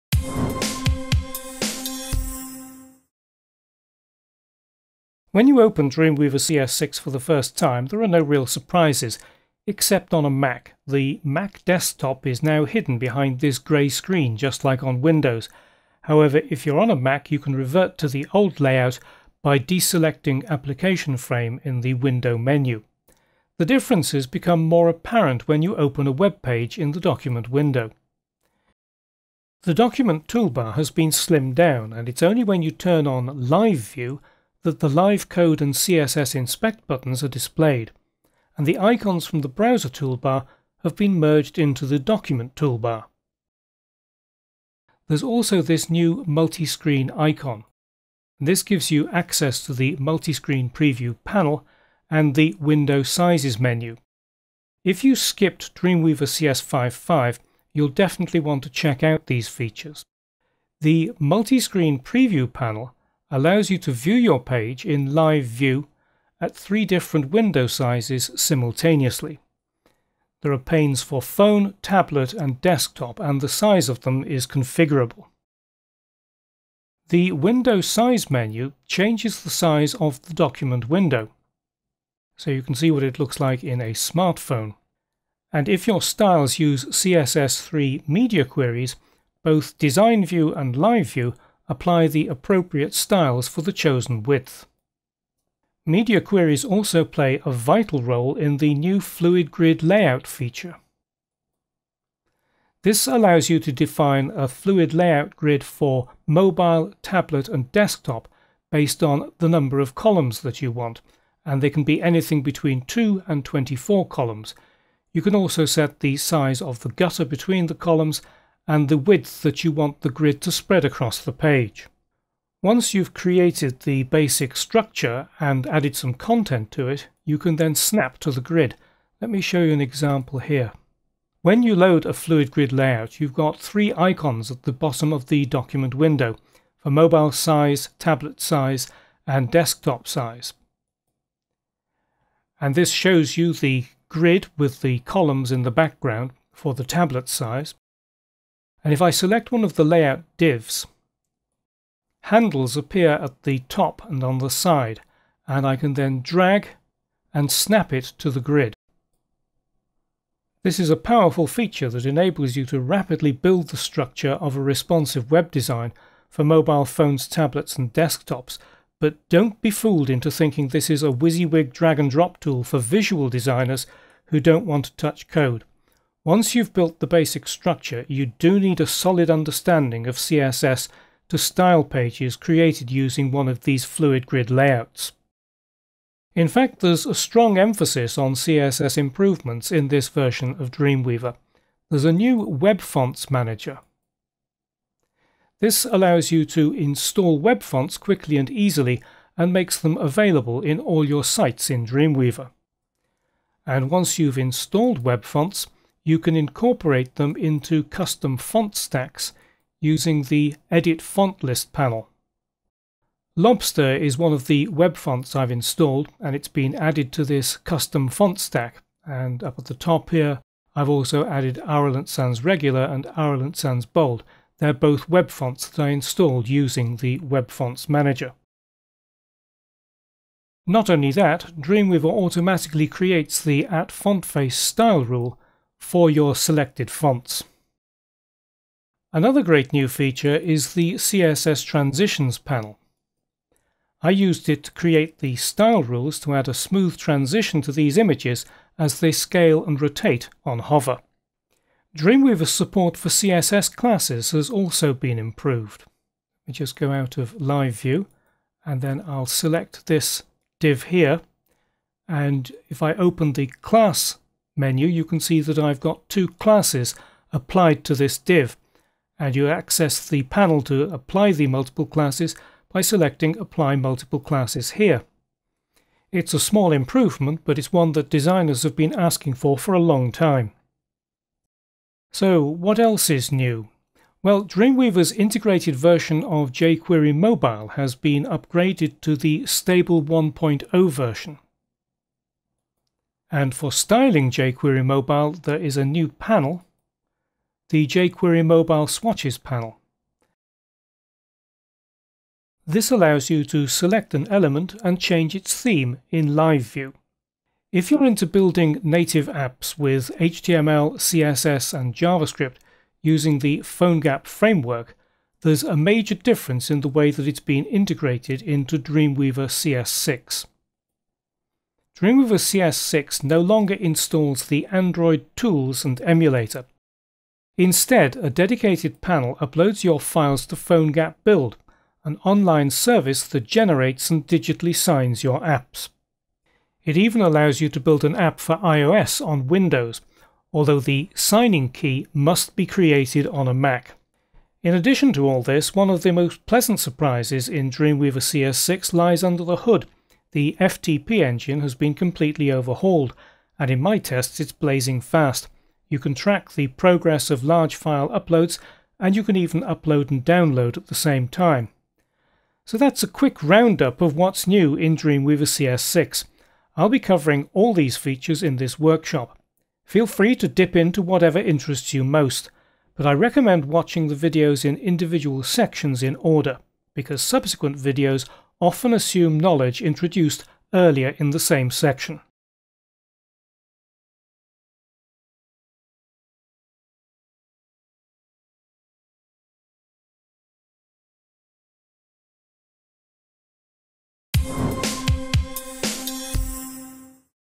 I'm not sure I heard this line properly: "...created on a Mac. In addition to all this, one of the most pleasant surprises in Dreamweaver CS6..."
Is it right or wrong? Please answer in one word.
right.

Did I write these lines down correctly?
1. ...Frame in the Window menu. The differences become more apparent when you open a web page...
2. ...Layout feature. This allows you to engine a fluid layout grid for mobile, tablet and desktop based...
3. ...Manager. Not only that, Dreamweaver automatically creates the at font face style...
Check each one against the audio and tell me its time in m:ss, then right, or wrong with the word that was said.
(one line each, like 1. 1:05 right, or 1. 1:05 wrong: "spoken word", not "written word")
1. 0:21 right
2. 1:39 wrong: "define", not "engine"
3. 3:47 right.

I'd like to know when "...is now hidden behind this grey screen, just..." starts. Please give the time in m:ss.
0:12.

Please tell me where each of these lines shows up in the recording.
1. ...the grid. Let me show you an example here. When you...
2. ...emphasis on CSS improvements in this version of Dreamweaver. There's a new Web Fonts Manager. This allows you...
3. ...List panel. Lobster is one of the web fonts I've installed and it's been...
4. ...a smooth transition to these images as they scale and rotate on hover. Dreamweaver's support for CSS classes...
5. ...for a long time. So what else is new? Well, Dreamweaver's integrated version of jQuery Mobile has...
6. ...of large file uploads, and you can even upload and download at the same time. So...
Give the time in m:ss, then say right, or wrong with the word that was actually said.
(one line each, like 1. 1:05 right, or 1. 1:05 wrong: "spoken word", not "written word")
1. 2:08 right
2. 3:07 right
3. 3:31 right
4. 4:06 right
5. 4:39 right
6. 5:57 right.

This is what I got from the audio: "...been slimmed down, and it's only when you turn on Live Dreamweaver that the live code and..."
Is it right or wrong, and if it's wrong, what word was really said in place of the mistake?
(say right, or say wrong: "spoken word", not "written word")
wrong: "View", not "Dreamweaver".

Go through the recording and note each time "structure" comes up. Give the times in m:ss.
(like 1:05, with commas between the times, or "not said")
2:04, 2:43, 2:57.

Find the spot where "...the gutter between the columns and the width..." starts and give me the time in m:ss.
1:56.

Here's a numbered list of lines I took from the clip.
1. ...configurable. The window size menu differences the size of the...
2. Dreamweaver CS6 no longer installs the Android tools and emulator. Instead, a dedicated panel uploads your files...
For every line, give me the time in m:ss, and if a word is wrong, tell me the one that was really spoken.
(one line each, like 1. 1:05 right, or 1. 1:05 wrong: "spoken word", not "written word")
1. 1:14 wrong: "changes", not "differences"
2. 5:22 right.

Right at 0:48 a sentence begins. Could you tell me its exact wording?
This gives you access to the multi-screen preview panel and the window sizes menu.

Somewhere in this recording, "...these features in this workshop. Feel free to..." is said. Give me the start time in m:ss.
6:07.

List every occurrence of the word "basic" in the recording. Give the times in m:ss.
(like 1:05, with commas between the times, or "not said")
2:04, 2:57.